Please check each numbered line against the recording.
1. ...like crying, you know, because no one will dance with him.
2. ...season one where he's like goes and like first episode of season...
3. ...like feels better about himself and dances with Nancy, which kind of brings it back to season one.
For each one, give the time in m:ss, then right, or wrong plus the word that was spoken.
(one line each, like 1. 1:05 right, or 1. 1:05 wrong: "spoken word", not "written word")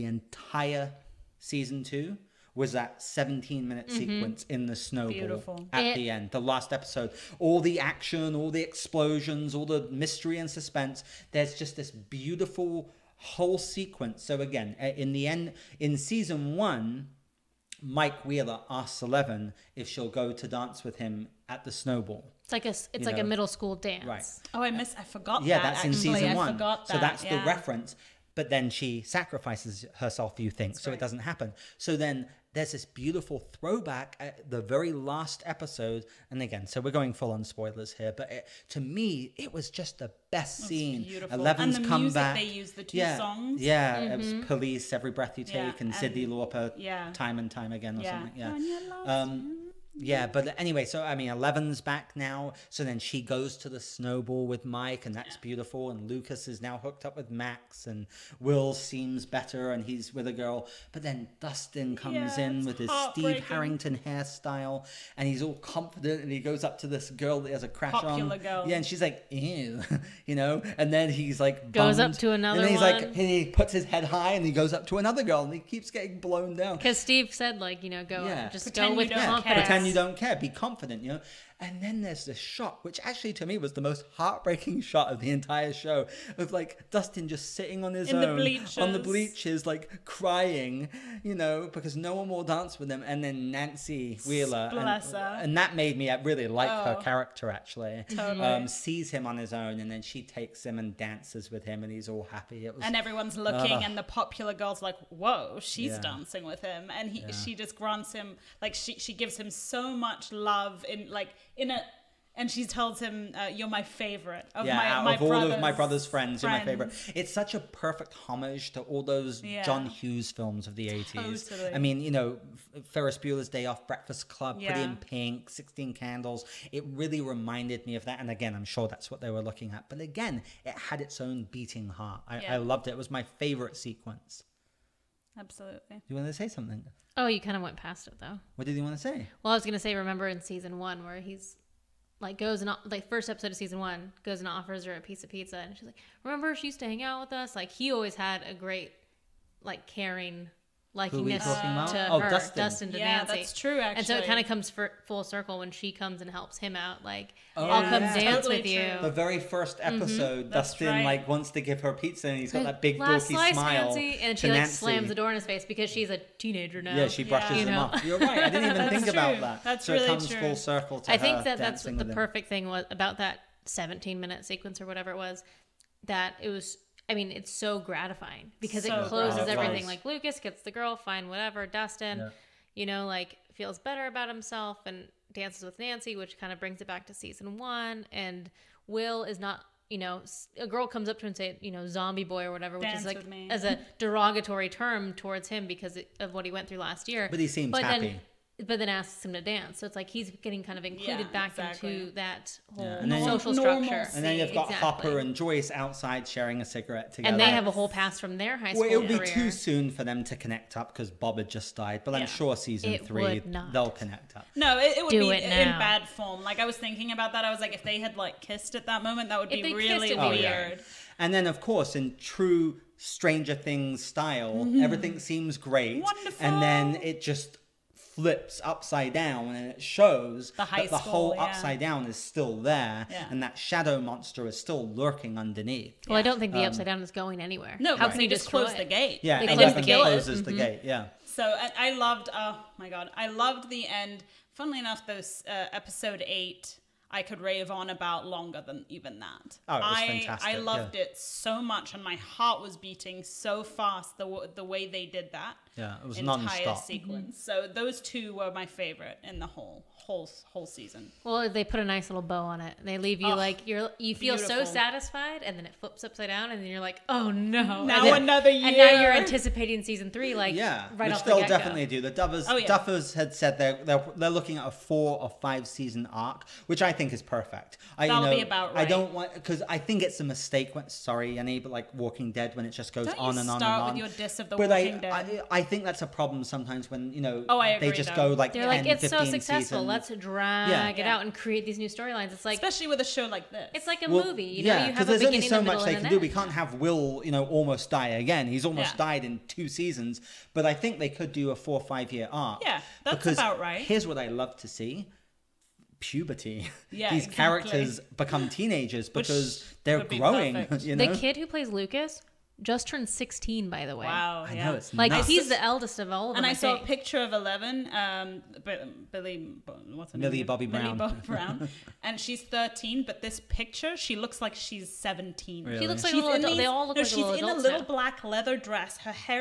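1. 1:29 right
2. 2:20 right
3. 3:03 right.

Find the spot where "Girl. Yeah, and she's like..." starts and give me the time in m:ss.
1:08.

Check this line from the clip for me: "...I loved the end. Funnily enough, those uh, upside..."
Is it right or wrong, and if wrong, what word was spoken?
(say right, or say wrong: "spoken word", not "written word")
wrong: "episode", not "upside".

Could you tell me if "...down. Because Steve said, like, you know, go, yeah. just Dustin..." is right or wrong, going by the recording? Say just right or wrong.
wrong.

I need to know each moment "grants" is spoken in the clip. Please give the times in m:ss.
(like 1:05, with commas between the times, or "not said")
1:47.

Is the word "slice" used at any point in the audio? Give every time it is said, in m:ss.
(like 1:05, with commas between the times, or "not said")
2:43.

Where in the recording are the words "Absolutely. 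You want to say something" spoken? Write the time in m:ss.
2:15.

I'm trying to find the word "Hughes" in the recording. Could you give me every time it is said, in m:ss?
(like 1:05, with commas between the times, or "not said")
1:59.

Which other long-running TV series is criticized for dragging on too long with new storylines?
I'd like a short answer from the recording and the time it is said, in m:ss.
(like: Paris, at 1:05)
Walking Dead, at 4:41.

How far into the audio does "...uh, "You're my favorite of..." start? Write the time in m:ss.
1:53.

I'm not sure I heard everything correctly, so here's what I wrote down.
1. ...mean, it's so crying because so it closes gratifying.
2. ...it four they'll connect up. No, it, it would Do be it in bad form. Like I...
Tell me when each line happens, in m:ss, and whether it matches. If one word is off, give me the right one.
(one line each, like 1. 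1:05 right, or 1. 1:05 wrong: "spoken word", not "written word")
1. 2:57 wrong: "gratifying", not "crying"
2. 3:32 wrong: "three", not "four".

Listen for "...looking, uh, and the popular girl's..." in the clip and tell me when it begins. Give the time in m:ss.
1:43.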